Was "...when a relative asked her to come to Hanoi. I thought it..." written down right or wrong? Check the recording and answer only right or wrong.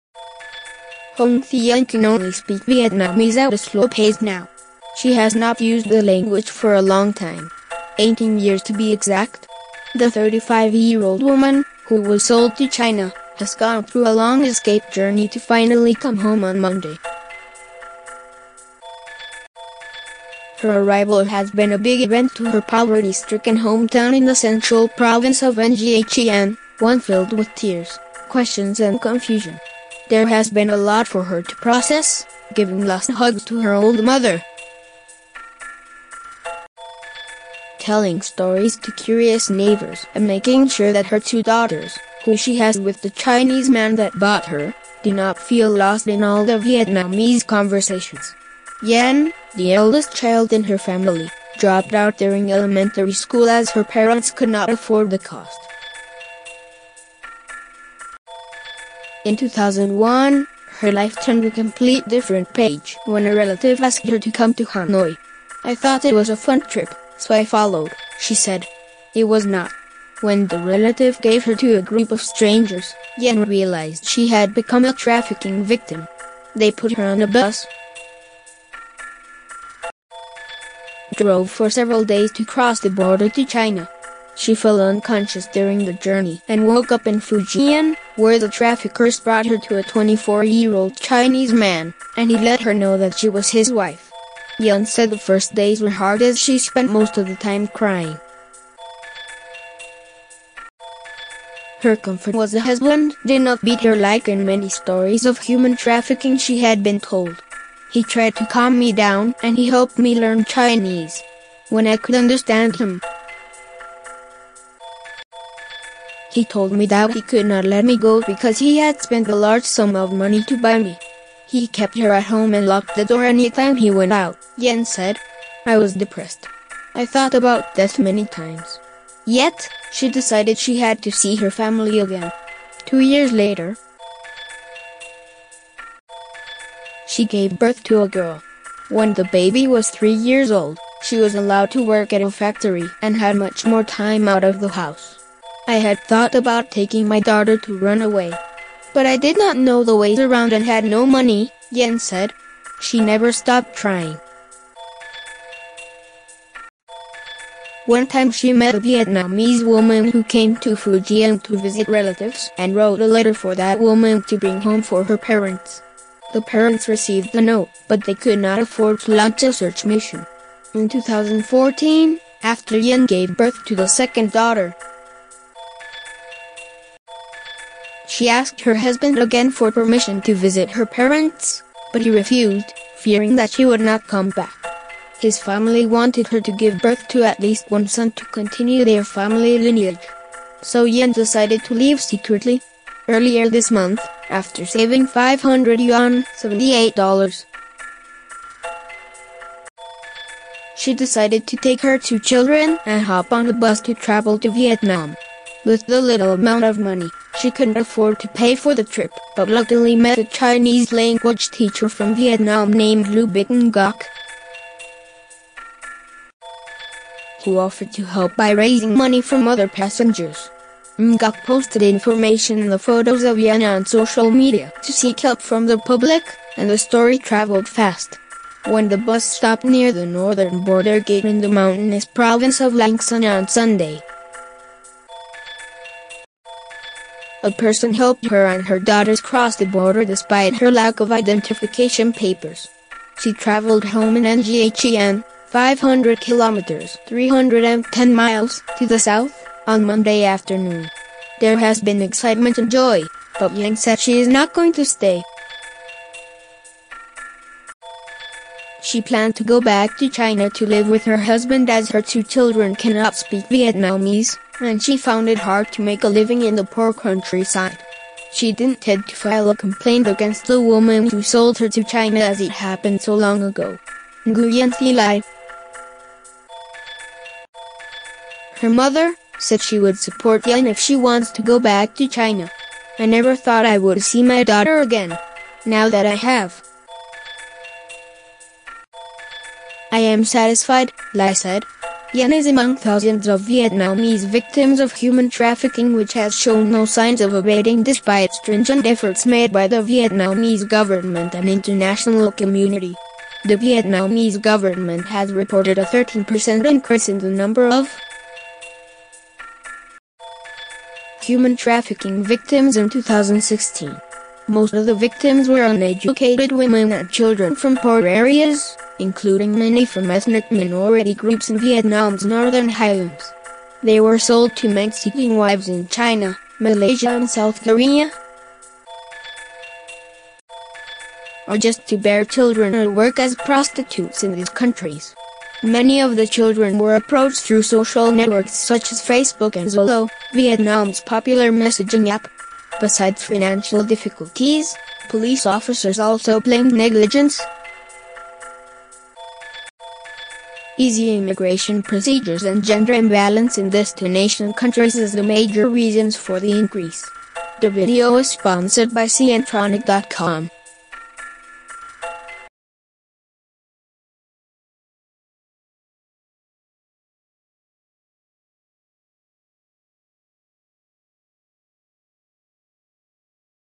right.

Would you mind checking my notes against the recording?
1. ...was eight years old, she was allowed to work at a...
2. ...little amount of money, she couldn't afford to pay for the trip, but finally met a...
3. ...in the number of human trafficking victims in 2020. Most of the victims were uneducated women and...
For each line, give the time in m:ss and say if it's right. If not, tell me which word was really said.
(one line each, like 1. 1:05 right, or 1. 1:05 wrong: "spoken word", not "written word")
1. 2:19 wrong: "three", not "eight"
2. 3:26 wrong: "luckily", not "finally"
3. 5:07 wrong: "2016", not "2020".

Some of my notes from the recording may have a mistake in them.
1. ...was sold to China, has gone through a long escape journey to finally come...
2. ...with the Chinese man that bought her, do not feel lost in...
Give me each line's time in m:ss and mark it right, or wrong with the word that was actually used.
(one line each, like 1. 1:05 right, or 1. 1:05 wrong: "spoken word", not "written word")
1. 0:12 right
2. 0:42 right.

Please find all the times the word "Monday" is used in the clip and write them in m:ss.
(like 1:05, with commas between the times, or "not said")
0:16, 4:09.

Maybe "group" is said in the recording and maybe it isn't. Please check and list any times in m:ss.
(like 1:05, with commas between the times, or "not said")
1:11, 5:21.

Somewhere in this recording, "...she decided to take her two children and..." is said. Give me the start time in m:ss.
3:20.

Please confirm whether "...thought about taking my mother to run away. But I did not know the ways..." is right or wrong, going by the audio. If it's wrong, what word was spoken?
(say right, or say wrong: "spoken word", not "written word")
wrong: "daughter", not "mother".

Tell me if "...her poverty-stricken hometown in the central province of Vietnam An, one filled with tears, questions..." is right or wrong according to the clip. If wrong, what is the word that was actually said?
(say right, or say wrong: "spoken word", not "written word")
wrong: "Nghe", not "Vietnam".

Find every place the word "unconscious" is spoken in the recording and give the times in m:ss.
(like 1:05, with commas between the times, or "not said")
1:24.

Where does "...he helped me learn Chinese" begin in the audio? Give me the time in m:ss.
1:49.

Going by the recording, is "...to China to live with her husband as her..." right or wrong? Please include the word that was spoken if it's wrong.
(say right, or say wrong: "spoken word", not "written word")
right.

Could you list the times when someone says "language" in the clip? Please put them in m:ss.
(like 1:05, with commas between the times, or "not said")
0:06, 3:30.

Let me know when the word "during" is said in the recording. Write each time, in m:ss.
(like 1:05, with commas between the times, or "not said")
0:52, 1:25.